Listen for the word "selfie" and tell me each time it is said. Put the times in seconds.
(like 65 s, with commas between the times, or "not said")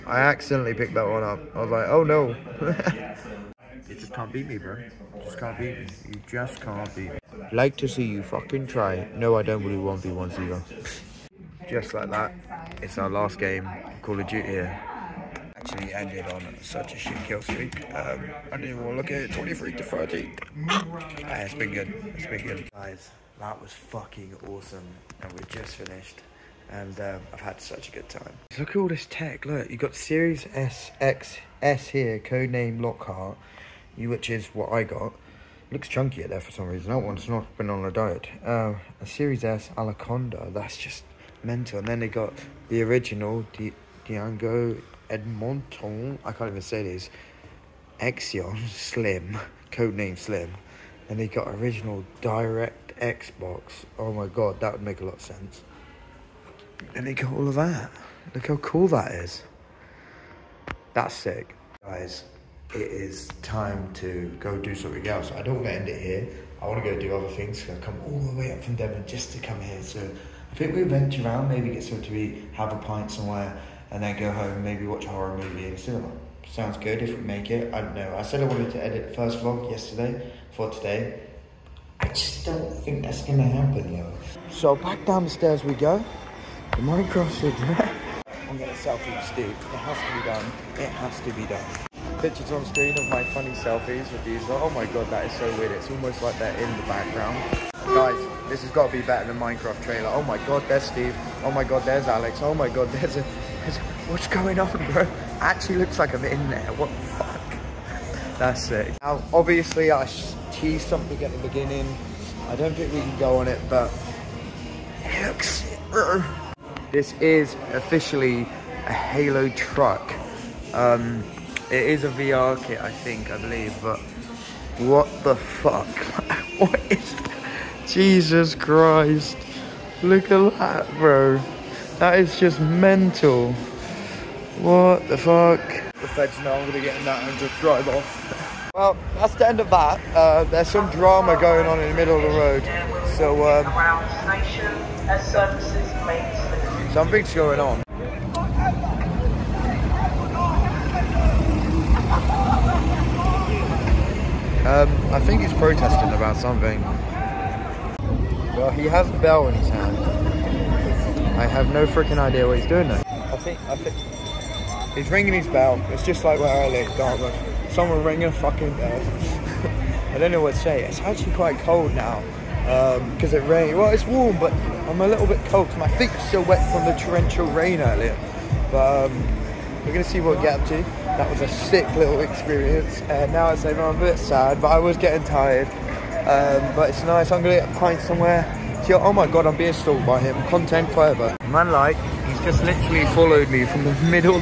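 88 s, 93 s.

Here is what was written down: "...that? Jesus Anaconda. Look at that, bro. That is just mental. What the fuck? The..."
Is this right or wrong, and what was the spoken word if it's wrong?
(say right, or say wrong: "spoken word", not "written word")
wrong: "Christ", not "Anaconda".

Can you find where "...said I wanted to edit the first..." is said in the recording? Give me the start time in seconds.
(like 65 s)
78 s.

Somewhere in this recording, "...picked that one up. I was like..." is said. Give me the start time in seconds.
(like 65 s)
0 s.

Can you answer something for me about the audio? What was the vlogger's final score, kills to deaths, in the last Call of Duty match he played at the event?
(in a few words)
23 to 13.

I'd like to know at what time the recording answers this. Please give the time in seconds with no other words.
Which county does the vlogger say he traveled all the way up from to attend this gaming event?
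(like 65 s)
68 s.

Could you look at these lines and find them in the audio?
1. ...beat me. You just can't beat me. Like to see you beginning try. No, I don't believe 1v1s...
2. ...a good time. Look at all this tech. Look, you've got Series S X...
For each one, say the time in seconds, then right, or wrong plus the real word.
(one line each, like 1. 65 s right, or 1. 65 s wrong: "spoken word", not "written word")
1. 5 s wrong: "fucking", not "beginning"
2. 27 s right.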